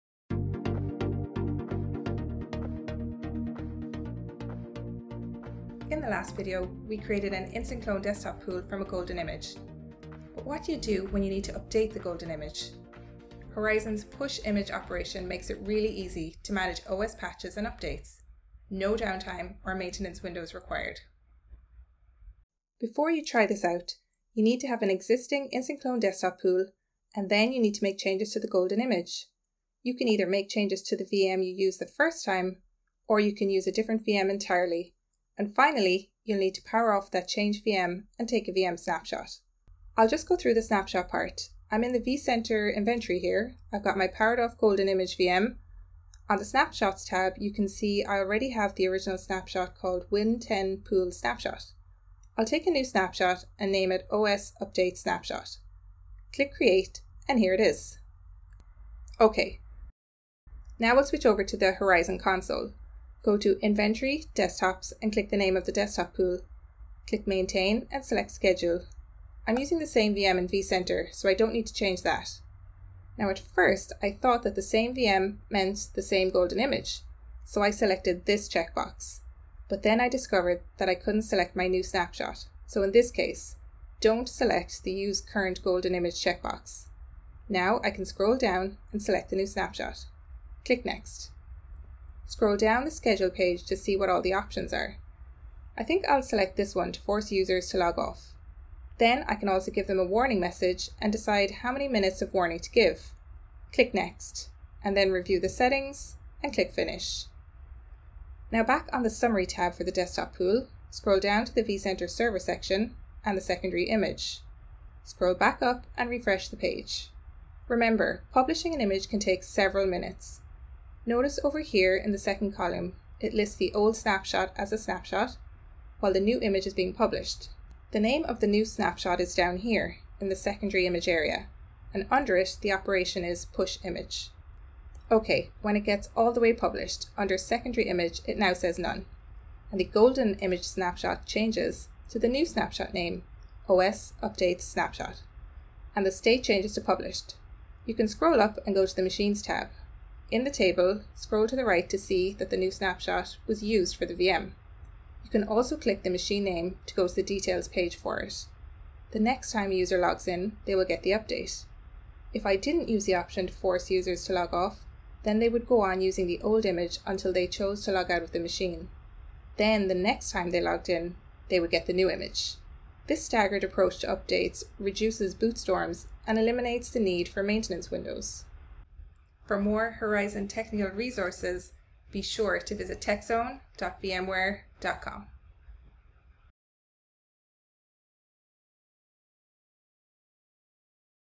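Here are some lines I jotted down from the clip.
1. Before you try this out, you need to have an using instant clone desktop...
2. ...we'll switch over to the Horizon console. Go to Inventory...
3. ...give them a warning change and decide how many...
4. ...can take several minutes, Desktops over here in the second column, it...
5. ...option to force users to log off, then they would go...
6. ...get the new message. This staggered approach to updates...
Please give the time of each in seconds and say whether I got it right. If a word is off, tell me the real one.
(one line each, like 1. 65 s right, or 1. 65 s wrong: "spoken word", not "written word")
1. 22 s wrong: "existing", not "using"
2. 60 s right
3. 99 s wrong: "message", not "change"
4. 119 s wrong: "Notice", not "Desktops"
5. 163 s right
6. 171 s wrong: "image", not "message".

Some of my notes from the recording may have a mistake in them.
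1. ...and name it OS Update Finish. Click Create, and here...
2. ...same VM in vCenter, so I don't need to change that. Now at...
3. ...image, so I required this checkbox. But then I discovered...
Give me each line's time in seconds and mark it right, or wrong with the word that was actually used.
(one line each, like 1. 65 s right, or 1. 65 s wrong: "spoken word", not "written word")
1. 53 s wrong: "Snapshot", not "Finish"
2. 69 s right
3. 76 s wrong: "selected", not "required".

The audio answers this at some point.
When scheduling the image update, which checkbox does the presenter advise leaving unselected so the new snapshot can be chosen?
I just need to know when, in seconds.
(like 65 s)
84 s.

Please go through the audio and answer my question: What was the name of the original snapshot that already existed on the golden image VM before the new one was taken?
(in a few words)
Win10 Pool Snapshot.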